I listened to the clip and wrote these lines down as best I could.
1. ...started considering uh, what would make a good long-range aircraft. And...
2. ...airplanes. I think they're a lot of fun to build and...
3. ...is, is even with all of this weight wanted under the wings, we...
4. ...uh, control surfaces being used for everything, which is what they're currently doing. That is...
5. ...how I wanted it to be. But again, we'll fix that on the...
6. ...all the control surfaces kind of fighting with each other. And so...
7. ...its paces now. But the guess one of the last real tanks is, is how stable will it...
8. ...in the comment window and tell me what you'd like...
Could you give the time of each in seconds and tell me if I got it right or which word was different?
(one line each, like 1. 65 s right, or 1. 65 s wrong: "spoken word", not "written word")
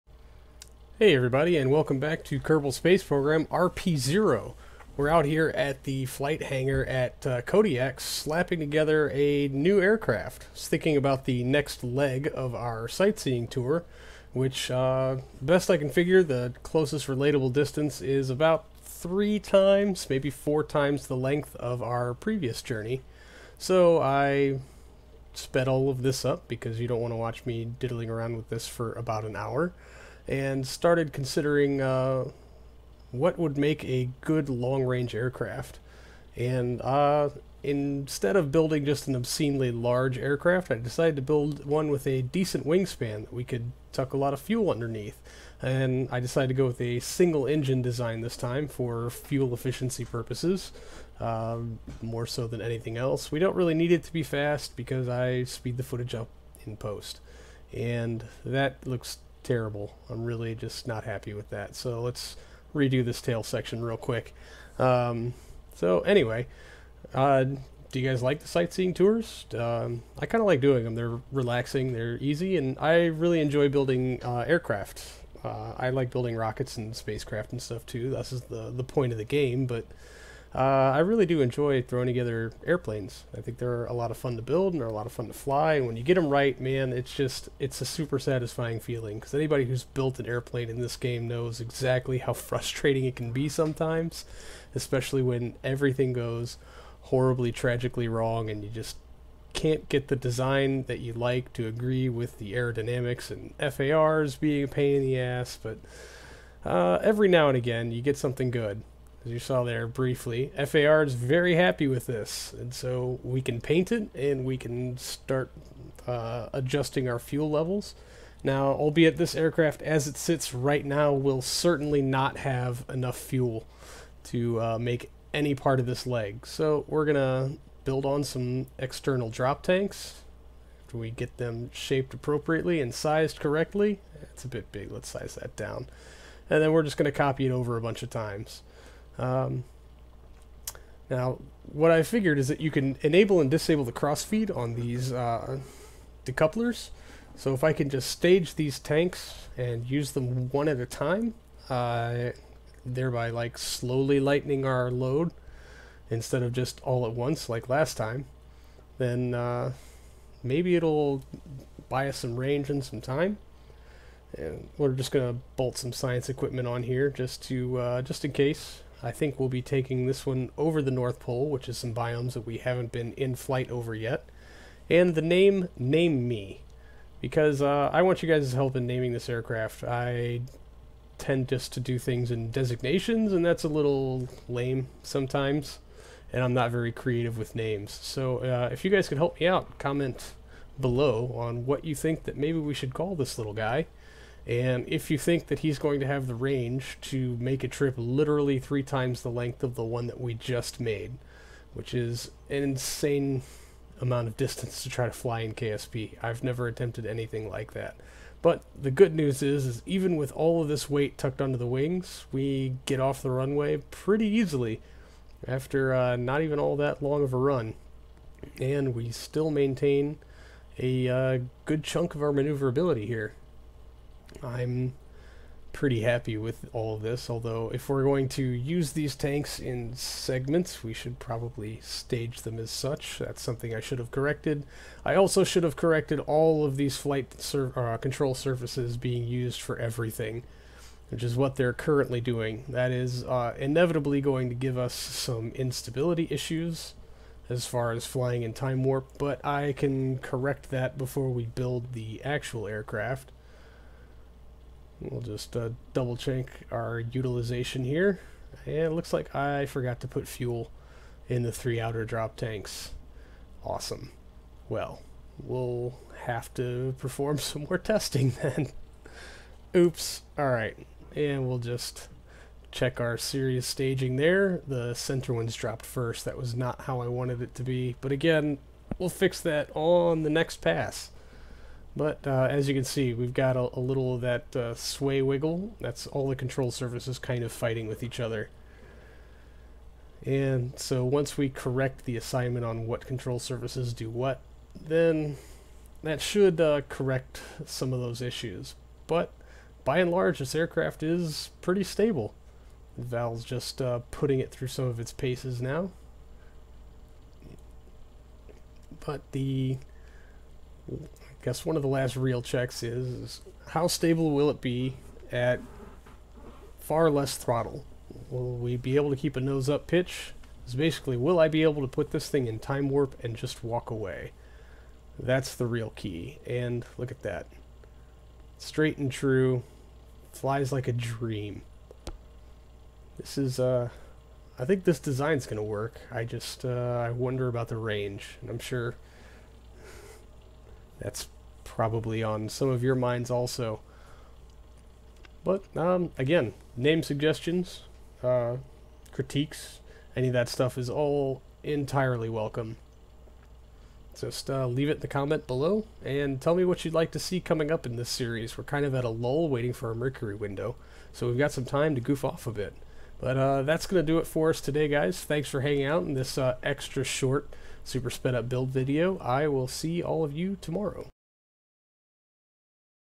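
1. 30 s right
2. 82 s right
3. 209 s wrong: "tucked", not "wanted"
4. 237 s right
5. 276 s right
6. 286 s right
7. 304 s wrong: "checks", not "tanks"
8. 354 s wrong: "below", not "window".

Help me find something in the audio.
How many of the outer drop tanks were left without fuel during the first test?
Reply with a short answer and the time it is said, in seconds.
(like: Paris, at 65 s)
3, at 261 s.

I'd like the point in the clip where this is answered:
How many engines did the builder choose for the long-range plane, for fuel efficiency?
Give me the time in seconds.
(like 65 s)
47 s.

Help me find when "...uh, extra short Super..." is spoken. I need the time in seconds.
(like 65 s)
366 s.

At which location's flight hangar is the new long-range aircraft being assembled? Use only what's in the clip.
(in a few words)
Kodiak.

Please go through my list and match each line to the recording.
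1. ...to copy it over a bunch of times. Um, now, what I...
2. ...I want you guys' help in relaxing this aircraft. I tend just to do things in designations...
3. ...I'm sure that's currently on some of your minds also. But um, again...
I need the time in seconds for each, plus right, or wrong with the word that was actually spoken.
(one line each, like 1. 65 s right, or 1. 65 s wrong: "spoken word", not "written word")
1. 137 s right
2. 177 s wrong: "naming", not "relaxing"
3. 338 s wrong: "probably", not "currently".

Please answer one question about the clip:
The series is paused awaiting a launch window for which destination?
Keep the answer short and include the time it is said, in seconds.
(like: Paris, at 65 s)
Mercury, at 359 s.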